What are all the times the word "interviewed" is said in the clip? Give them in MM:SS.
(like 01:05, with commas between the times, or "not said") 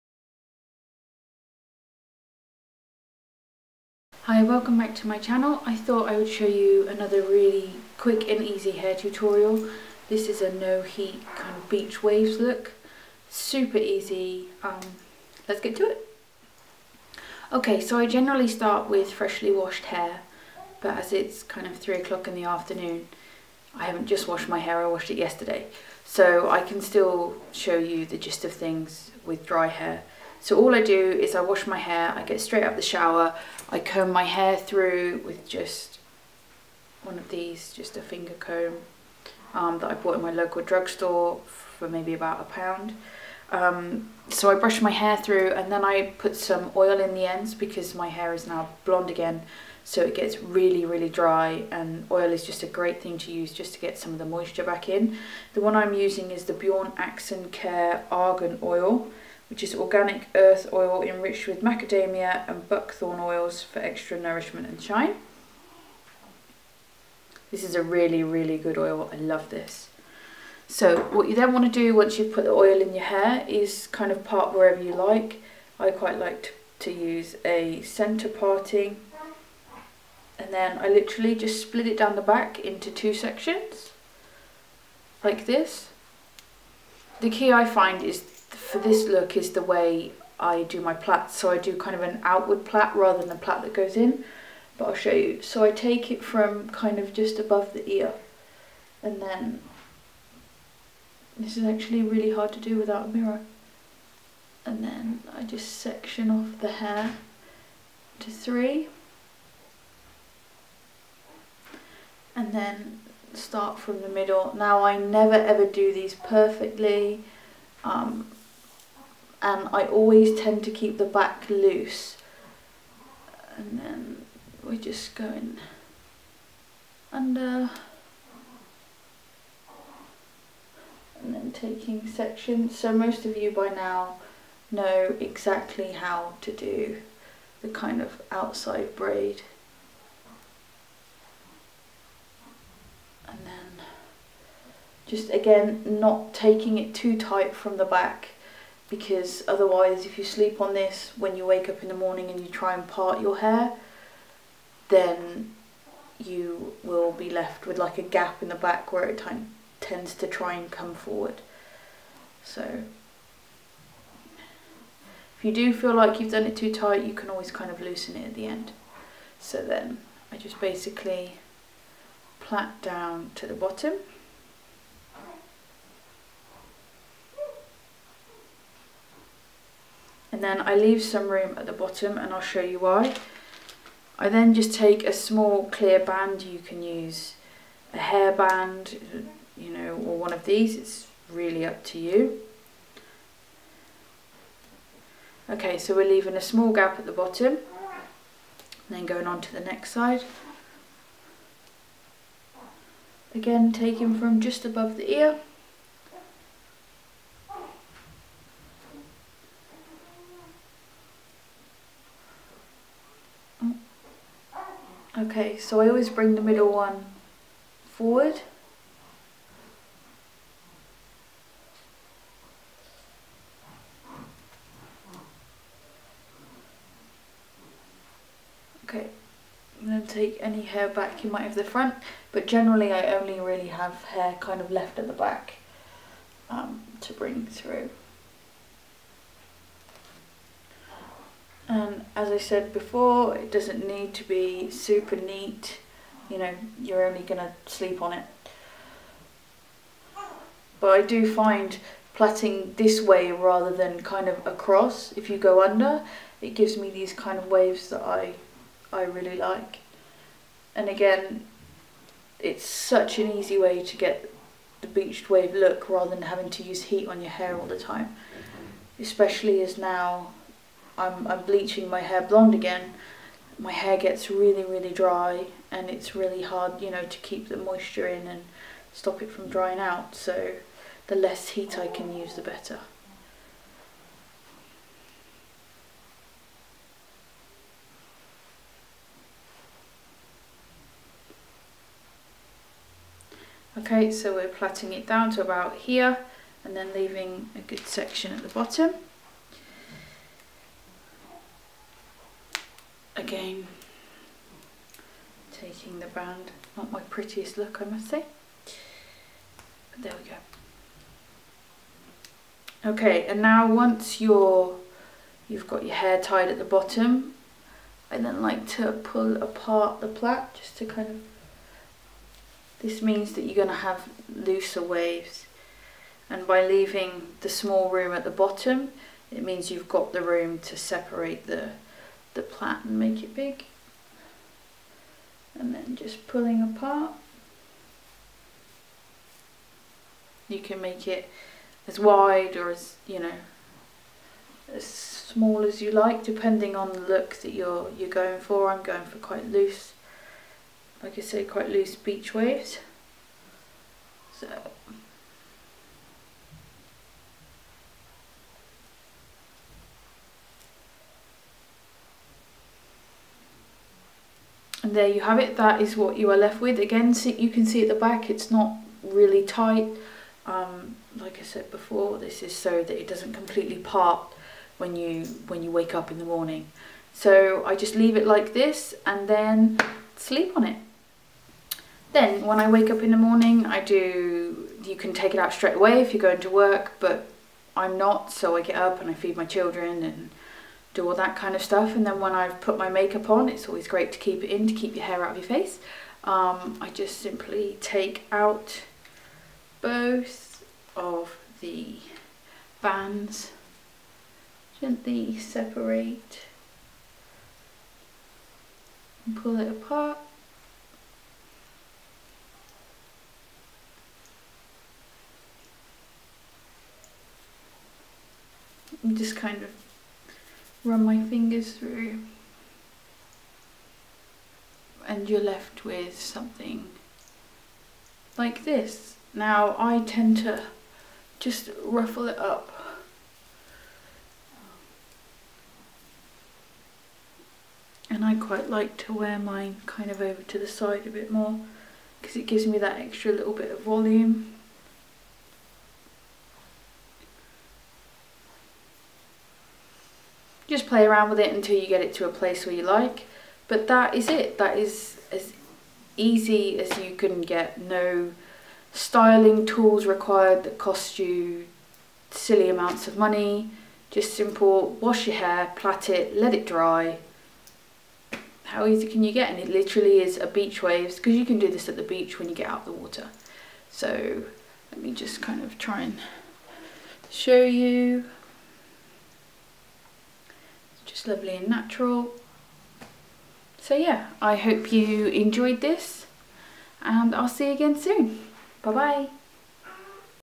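not said.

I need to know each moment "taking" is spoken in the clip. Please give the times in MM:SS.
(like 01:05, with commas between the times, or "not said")
02:11, 02:26, 03:23, 05:05.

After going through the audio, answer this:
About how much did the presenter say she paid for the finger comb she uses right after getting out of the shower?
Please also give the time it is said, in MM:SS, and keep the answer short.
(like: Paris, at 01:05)
about a pound, at 00:42.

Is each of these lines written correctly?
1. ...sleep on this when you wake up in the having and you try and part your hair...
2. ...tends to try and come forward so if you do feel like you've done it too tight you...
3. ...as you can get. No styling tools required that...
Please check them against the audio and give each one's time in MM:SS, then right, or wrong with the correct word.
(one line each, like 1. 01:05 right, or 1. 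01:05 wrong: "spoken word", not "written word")
1. 02:30 wrong: "morning", not "having"
2. 02:39 right
3. 07:36 right.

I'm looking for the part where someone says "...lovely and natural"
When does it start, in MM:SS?
08:01.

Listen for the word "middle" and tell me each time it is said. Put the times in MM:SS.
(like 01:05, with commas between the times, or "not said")
01:54, 03:36.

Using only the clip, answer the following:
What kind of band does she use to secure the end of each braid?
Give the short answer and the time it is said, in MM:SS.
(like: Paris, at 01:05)
small clear band, at 03:05.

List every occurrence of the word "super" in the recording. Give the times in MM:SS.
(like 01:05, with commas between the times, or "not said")
00:13, 04:04.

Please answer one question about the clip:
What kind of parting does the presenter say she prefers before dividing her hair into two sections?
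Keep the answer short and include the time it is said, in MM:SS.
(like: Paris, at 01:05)
centre parting, at 01:17.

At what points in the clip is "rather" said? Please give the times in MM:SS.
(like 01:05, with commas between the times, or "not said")
01:32, 04:13, 04:25.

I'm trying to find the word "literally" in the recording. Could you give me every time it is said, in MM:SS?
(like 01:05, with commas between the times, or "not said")
01:20, 07:49.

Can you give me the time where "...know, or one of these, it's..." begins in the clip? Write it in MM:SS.
03:09.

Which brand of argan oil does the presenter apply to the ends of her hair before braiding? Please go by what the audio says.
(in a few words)
Bjorn Axen.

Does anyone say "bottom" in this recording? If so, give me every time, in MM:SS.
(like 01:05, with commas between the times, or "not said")
02:53, 03:01, 03:17, 04:58, 05:16, 05:28.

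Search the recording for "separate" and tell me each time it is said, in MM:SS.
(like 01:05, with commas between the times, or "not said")
05:30, 06:45.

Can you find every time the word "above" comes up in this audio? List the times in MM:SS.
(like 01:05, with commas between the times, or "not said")
01:37, 03:24.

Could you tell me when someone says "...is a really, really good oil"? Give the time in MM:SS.
01:07.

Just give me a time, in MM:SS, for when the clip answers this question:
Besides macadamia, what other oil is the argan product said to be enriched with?
01:02.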